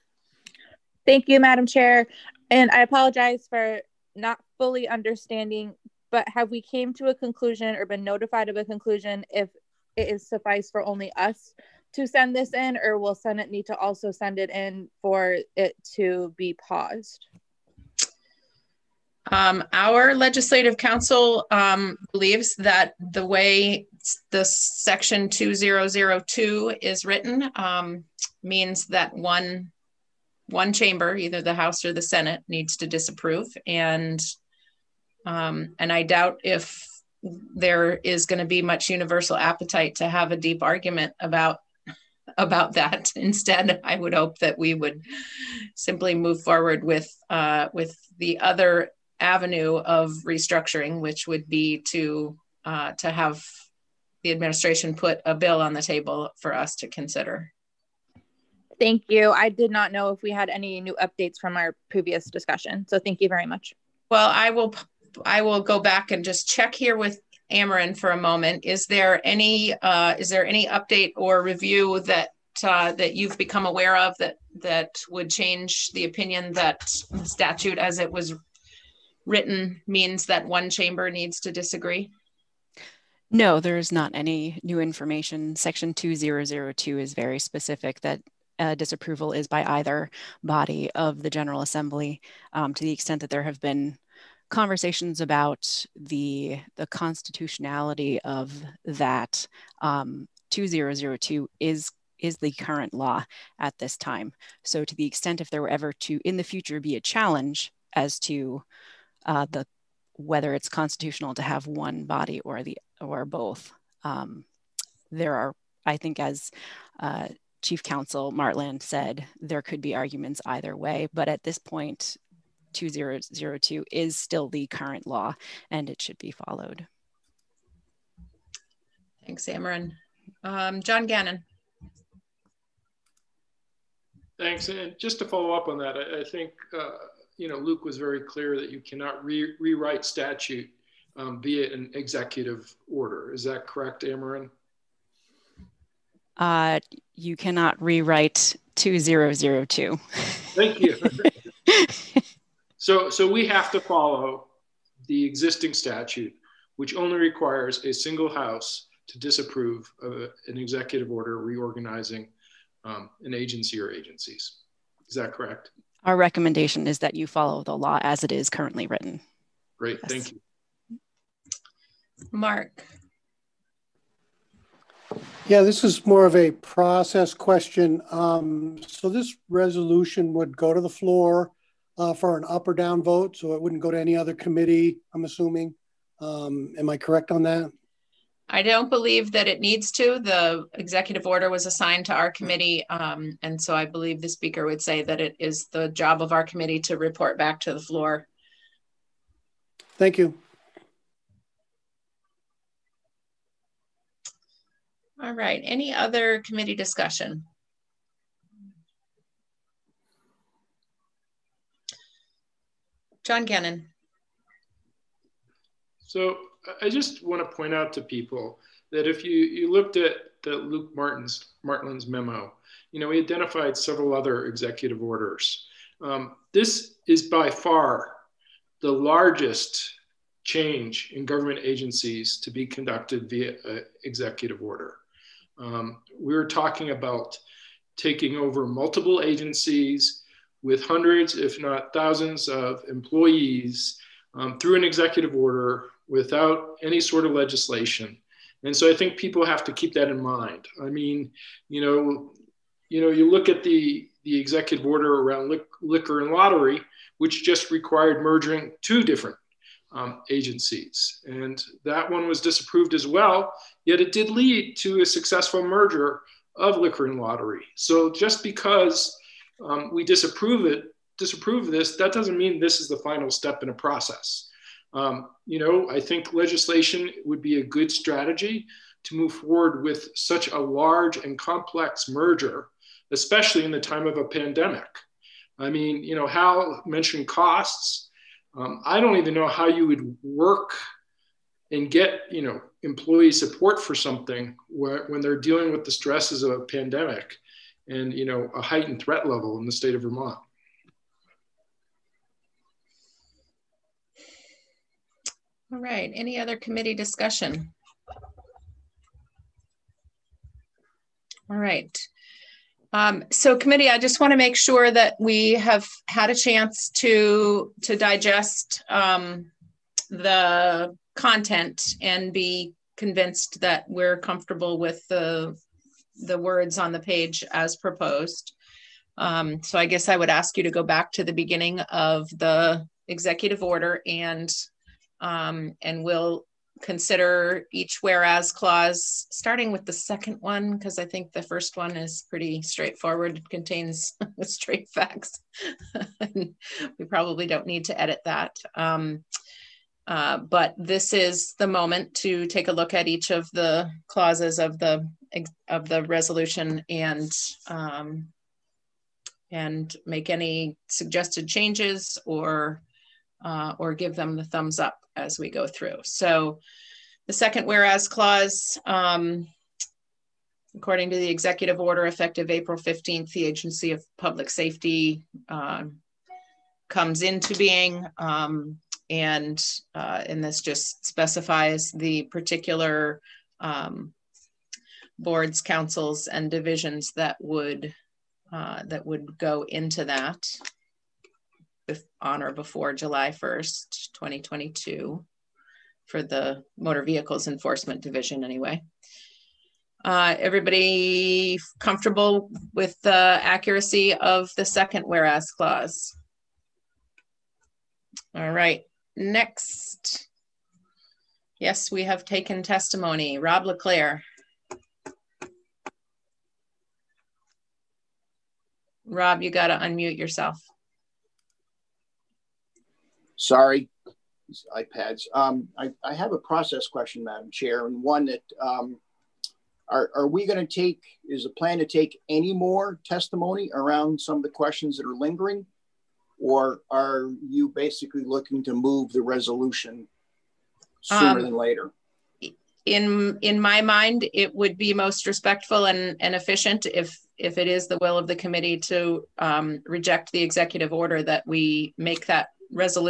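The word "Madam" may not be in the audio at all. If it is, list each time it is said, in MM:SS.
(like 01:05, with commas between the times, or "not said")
00:01, 07:07.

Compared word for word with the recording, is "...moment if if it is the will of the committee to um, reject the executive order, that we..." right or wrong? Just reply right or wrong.
wrong.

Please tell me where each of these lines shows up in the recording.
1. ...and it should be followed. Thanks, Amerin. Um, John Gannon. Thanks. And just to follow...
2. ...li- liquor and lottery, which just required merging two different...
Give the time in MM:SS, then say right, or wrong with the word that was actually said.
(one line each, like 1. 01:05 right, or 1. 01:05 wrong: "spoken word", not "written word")
1. 02:05 right
2. 04:15 right.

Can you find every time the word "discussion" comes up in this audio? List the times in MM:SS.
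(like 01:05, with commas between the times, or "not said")
01:02, 03:26, 05:06.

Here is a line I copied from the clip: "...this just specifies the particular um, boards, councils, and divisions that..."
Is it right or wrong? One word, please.
right.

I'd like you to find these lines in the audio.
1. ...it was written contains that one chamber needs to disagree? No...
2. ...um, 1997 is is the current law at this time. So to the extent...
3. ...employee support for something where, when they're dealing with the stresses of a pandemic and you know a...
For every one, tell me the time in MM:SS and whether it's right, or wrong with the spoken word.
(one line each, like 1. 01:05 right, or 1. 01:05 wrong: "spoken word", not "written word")
1. 01:17 wrong: "means", not "contains"
2. 01:39 wrong: "2002", not "1997"
3. 04:52 right.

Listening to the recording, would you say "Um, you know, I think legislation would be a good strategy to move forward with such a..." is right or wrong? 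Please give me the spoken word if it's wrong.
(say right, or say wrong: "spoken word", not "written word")
right.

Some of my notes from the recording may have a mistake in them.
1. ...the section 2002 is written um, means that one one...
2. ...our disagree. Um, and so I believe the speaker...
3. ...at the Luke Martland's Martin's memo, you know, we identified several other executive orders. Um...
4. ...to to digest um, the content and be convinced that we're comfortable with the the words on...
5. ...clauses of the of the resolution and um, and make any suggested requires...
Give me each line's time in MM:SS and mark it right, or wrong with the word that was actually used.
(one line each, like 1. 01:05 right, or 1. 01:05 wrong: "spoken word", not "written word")
1. 00:24 right
2. 03:12 wrong: "committee", not "disagree"
3. 03:39 right
4. 05:16 right
5. 05:54 wrong: "changes", not "requires".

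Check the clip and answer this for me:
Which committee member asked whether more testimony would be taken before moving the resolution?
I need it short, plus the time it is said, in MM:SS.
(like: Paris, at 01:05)
Rob LaClair, at 06:53.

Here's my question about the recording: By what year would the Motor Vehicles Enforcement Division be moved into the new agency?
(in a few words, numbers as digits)
2022.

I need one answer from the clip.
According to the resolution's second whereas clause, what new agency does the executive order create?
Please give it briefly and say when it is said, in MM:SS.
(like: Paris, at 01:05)
Agency of Public Safety, at 06:13.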